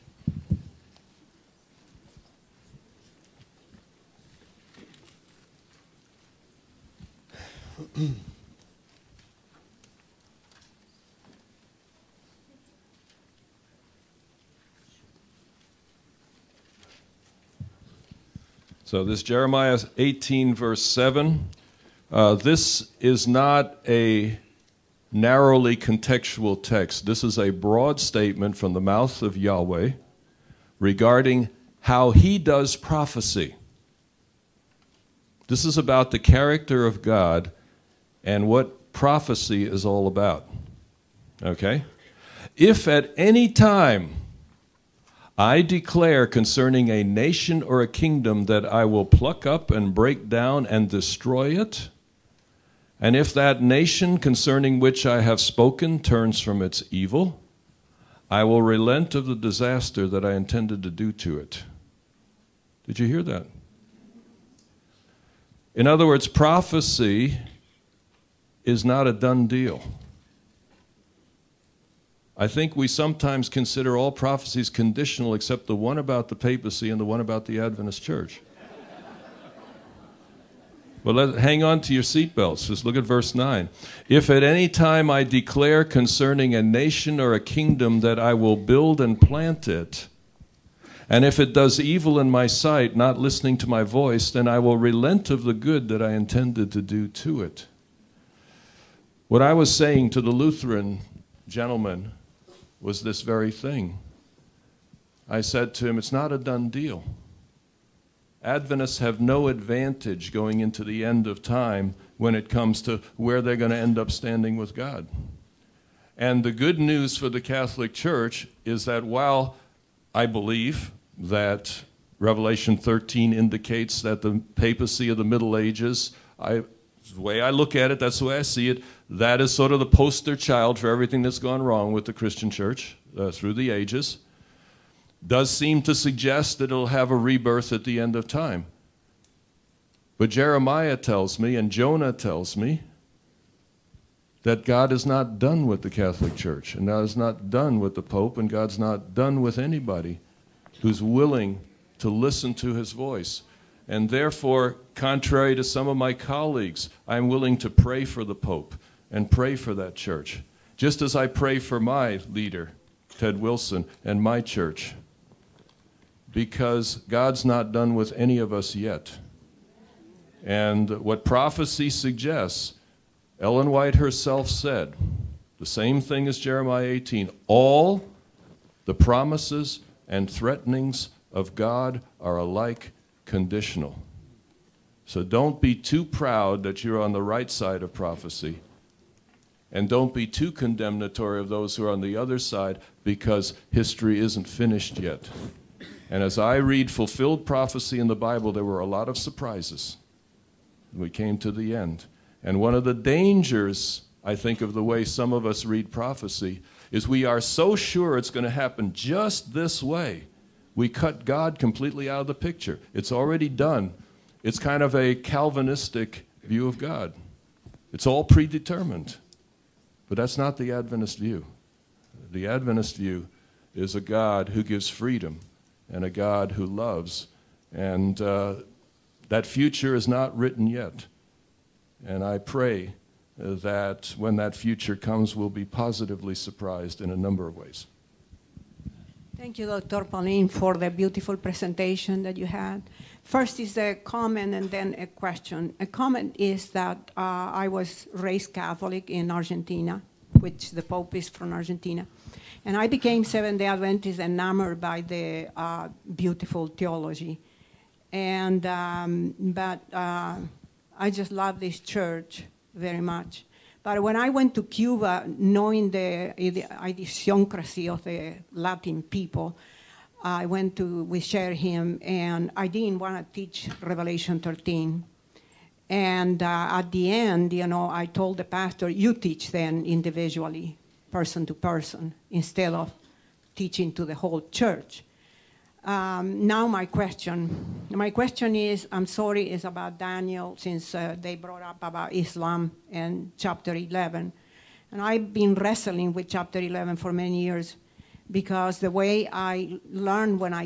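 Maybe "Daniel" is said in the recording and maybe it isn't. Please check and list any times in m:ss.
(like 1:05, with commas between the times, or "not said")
4:49.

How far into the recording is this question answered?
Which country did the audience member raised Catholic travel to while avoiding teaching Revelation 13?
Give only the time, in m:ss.
4:24.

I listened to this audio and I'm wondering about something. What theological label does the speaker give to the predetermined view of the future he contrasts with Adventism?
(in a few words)
Calvinistic.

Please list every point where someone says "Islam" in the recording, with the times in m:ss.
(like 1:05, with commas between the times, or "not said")
4:52.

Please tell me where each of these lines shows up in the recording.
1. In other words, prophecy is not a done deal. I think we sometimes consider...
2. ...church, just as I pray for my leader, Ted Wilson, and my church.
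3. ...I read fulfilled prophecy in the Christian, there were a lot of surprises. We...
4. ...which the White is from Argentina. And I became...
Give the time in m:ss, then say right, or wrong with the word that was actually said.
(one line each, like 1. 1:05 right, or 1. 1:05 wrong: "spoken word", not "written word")
1. 1:05 right
2. 2:39 right
3. 3:16 wrong: "Bible", not "Christian"
4. 4:10 wrong: "Pope", not "White".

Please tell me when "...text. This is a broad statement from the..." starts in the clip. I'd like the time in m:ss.
0:26.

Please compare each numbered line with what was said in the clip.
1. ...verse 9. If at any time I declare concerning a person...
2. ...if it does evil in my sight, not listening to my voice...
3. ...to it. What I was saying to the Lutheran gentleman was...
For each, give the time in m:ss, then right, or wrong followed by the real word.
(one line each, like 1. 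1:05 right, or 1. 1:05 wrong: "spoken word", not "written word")
1. 1:23 wrong: "nation", not "person"
2. 1:31 right
3. 1:37 right.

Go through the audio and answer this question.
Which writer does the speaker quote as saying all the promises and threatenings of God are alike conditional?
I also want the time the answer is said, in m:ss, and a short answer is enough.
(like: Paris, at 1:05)
Ellen White, at 2:53.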